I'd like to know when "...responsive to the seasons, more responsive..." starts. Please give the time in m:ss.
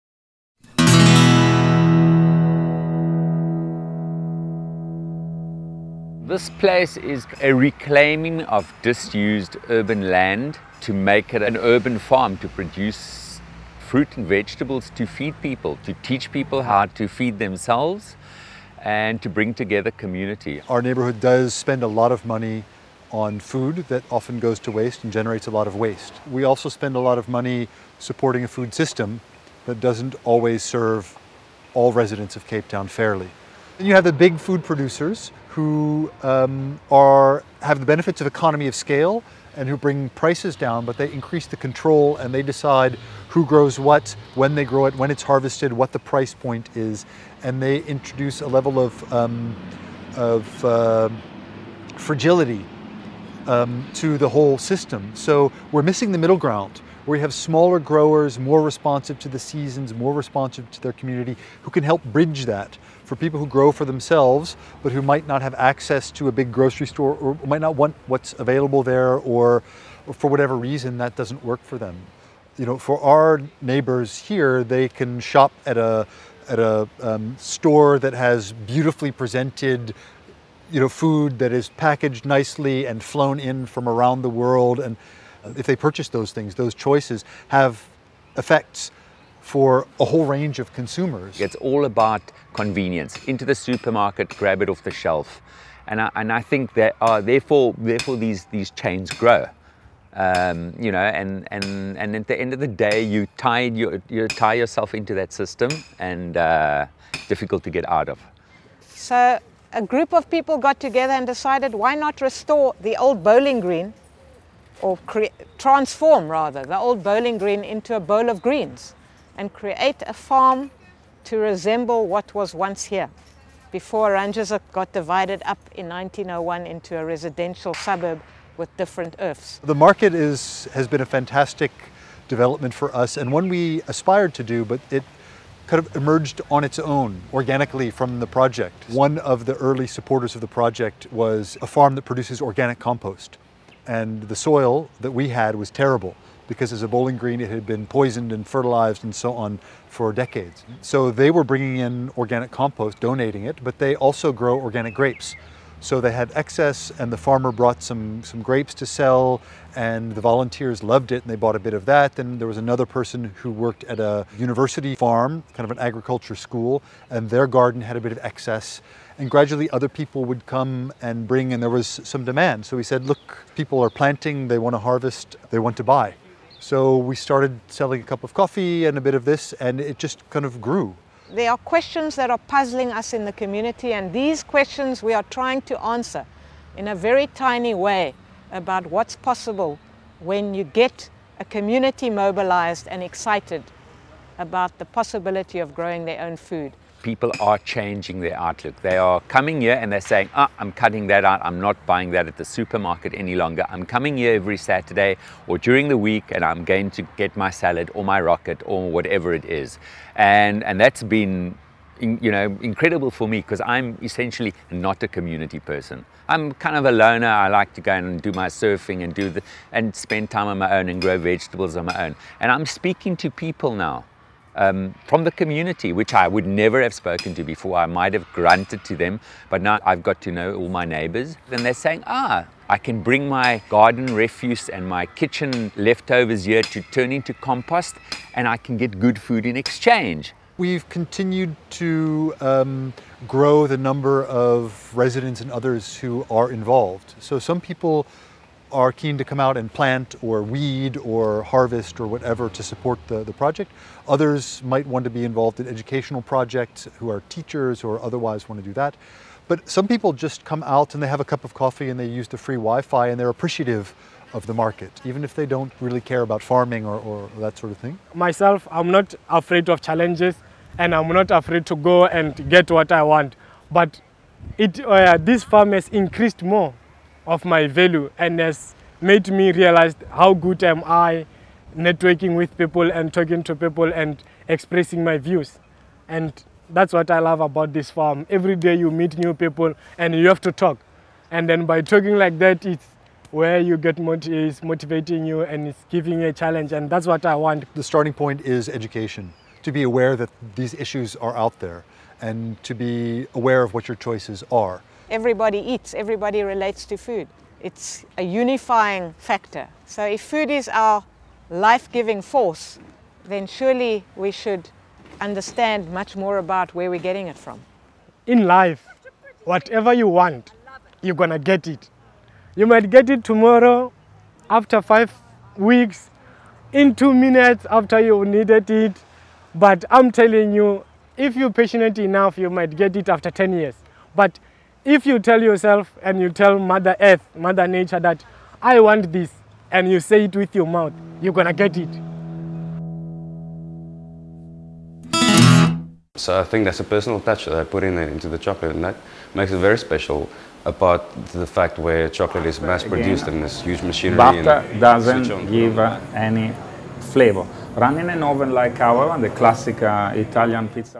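0:58.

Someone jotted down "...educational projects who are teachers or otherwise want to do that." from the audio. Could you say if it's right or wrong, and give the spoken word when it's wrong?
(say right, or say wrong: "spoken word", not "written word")
right.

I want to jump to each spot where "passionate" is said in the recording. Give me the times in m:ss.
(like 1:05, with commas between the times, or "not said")
5:31.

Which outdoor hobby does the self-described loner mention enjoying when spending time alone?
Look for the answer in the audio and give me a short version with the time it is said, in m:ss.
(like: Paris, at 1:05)
surfing, at 3:38.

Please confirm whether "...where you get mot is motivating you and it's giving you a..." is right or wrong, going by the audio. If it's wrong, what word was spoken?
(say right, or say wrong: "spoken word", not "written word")
right.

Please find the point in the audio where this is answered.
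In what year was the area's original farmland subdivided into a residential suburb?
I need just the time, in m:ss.
2:05.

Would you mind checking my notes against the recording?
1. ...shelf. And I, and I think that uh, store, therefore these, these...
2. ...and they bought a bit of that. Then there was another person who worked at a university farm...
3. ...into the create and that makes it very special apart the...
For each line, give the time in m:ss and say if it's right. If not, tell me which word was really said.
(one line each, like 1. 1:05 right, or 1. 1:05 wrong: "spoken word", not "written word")
1. 1:34 wrong: "therefore", not "store"
2. 2:41 right
3. 5:47 wrong: "chocolate", not "create".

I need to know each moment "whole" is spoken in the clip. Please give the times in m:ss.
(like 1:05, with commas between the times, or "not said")
0:54, 1:30.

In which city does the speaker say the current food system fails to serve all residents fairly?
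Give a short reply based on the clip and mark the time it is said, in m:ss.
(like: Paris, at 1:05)
Cape Town, at 0:32.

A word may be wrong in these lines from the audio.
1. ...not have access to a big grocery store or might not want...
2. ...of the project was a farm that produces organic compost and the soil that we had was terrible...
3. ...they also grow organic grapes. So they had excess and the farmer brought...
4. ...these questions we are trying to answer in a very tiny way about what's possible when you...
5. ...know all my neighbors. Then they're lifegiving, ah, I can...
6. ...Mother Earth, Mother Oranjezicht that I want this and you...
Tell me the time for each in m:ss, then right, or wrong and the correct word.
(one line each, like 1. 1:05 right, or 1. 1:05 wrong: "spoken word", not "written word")
1. 1:05 right
2. 2:20 right
3. 2:33 right
4. 3:04 right
5. 3:50 wrong: "saying", not "lifegiving"
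6. 5:36 wrong: "Nature", not "Oranjezicht".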